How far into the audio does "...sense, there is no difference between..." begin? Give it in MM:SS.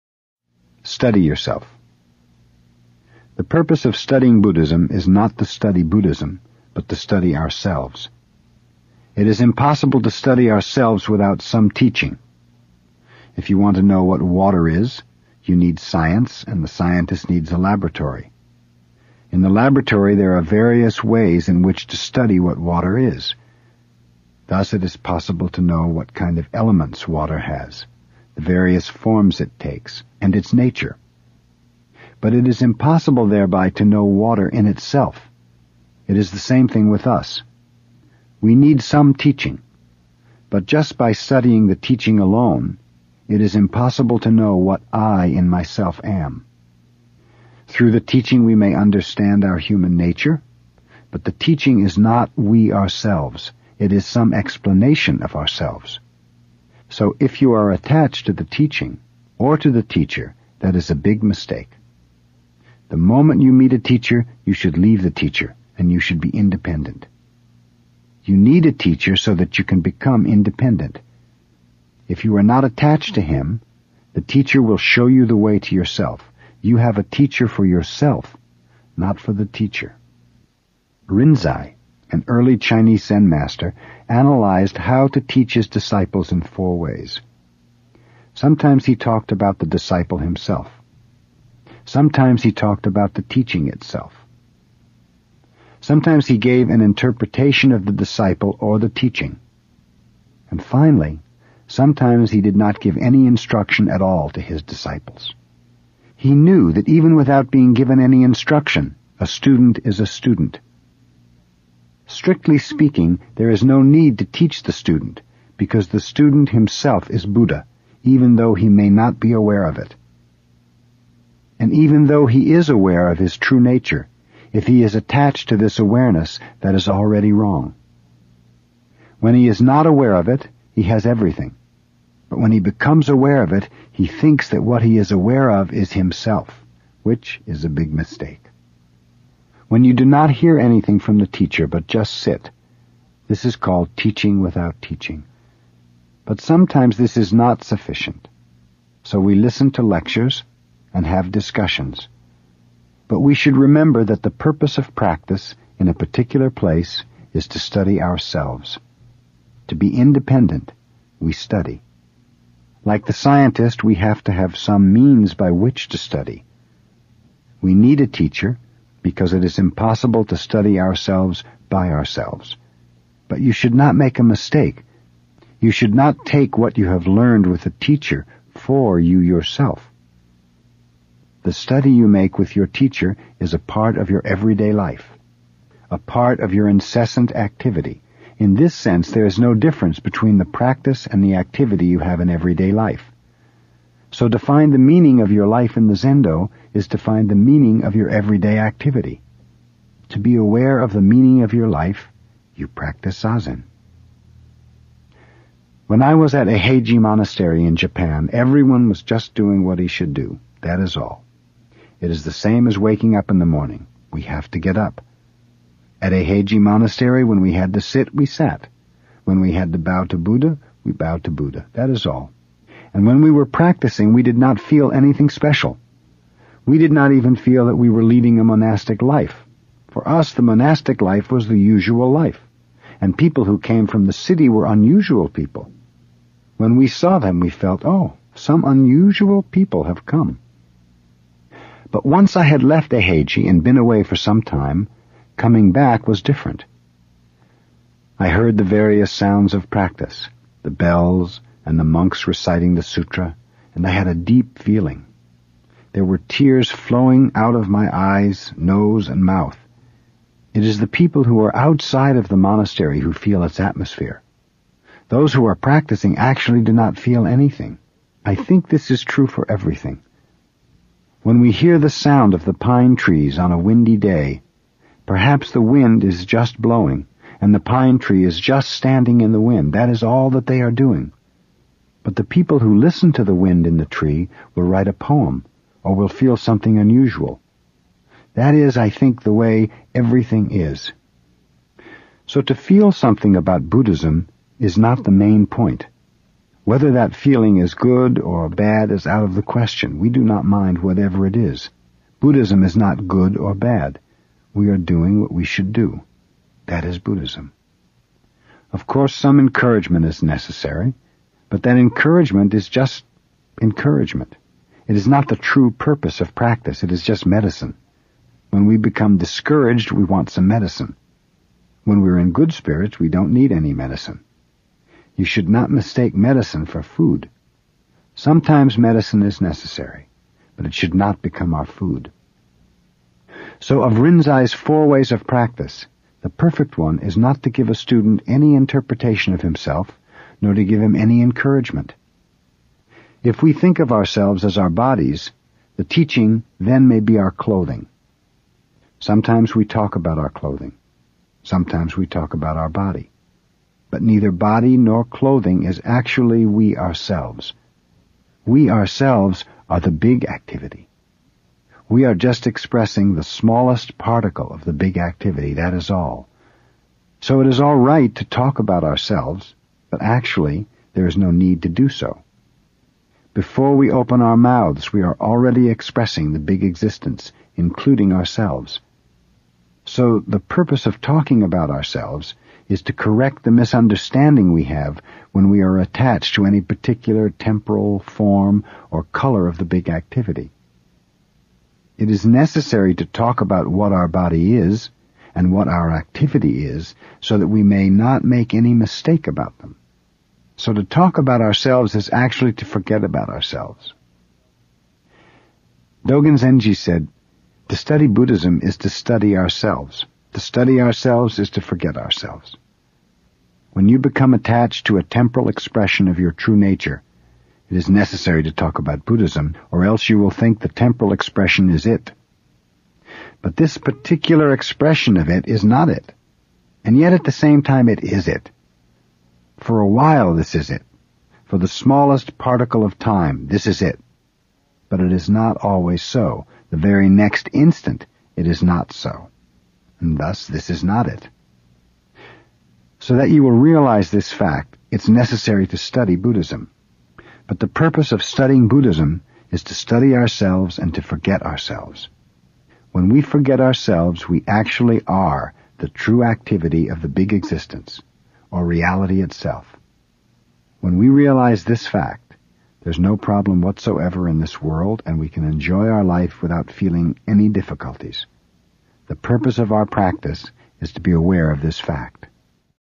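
03:08.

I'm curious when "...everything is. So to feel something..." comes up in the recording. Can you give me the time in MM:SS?
04:49.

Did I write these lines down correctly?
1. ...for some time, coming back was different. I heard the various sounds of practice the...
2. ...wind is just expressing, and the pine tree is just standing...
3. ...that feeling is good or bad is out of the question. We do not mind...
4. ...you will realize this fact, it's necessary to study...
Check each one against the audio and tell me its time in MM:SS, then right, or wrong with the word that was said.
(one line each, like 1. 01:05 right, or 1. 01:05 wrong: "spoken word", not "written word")
1. 04:04 right
2. 04:35 wrong: "blowing", not "expressing"
3. 04:56 right
4. 07:23 right.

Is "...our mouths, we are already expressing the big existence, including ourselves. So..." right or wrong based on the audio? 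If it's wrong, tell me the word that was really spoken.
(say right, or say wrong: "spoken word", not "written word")
right.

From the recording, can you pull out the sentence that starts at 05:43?
If we think of ourselves as our bodies, the teaching then may be our clothing.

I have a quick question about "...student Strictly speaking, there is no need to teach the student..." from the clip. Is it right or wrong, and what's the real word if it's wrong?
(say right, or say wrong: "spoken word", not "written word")
right.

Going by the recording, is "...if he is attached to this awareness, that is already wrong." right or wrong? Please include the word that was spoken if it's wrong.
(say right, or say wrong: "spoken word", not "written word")
right.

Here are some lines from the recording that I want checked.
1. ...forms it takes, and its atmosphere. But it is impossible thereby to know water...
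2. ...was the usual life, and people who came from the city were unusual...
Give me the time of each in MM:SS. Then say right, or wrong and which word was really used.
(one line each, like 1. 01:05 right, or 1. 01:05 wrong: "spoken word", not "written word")
1. 00:28 wrong: "nature", not "atmosphere"
2. 03:51 right.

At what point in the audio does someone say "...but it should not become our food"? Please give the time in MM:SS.
05:30.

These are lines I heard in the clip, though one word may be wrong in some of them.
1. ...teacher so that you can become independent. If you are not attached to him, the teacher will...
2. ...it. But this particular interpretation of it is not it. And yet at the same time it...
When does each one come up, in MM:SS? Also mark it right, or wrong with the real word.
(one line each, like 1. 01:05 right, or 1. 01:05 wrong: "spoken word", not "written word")
1. 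01:08 right
2. 07:01 wrong: "expression", not "interpretation".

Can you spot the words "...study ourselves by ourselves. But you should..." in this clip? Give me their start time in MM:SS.
02:50.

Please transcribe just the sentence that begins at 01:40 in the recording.
And finally, sometimes he did not give any instruction at all to his disciples.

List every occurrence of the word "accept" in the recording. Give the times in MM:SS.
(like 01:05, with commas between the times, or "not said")
not said.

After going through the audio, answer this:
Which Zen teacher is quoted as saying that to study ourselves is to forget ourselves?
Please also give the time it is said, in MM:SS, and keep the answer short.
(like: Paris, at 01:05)
Dogen Zenji, at 06:46.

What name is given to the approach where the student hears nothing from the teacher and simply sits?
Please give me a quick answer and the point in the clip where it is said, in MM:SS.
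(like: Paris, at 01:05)
Teaching without teaching, at 02:23.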